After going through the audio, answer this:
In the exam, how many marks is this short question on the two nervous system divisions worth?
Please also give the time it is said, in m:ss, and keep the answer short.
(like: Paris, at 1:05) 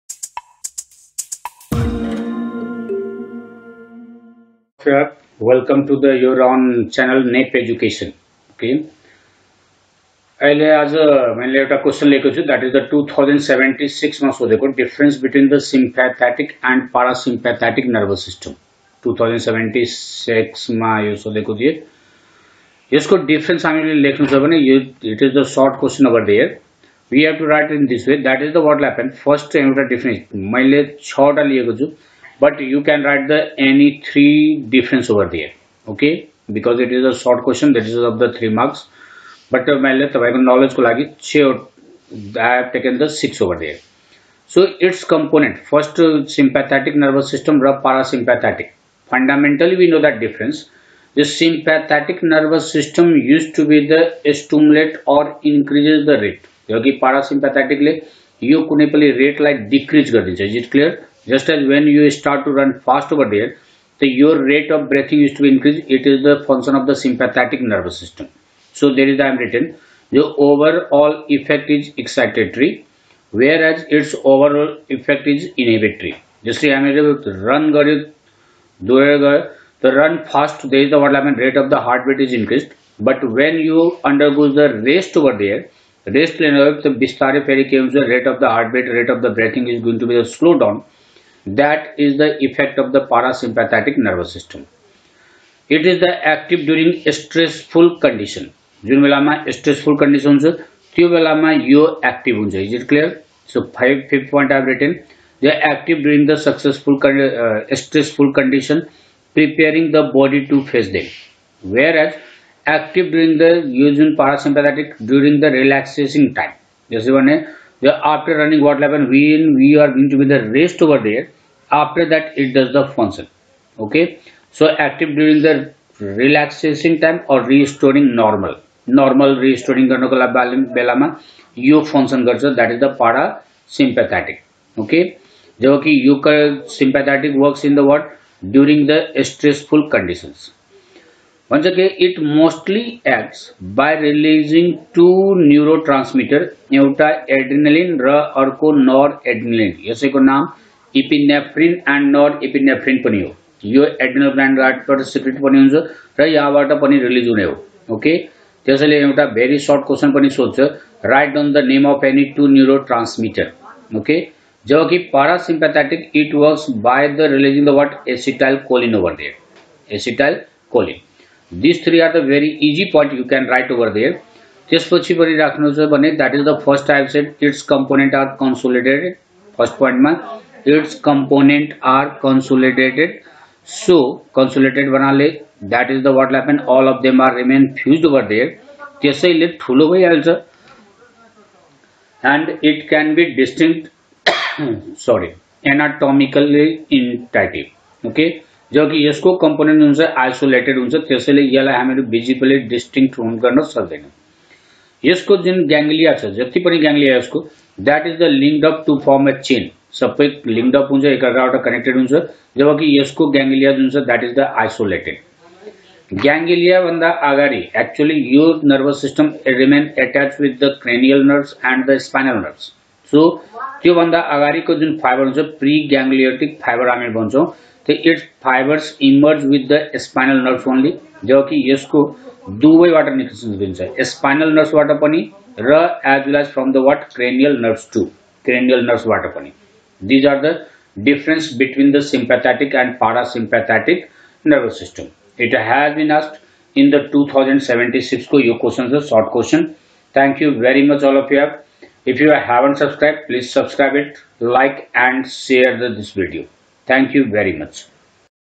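3, at 0:38.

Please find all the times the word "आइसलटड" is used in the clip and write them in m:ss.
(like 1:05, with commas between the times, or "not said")
3:20, 3:34.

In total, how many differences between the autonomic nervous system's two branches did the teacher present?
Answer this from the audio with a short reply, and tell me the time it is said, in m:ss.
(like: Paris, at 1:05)
6, at 0:31.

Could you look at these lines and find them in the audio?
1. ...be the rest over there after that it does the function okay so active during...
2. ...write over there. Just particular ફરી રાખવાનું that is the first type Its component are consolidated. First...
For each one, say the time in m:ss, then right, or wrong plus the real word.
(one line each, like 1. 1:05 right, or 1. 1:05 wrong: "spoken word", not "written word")
1. 2:00 right
2. 2:53 right.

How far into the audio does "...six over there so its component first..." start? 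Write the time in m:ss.
0:43.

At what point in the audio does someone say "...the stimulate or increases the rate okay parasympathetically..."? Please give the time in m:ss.
0:53.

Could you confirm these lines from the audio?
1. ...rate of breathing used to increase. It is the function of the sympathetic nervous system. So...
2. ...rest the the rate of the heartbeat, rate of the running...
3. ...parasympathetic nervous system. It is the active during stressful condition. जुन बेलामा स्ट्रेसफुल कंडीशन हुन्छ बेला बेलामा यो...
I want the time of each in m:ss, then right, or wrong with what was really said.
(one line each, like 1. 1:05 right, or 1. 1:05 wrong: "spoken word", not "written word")
1. 1:04 right
2. 1:26 wrong: "breathing", not "running"
3. 1:33 right.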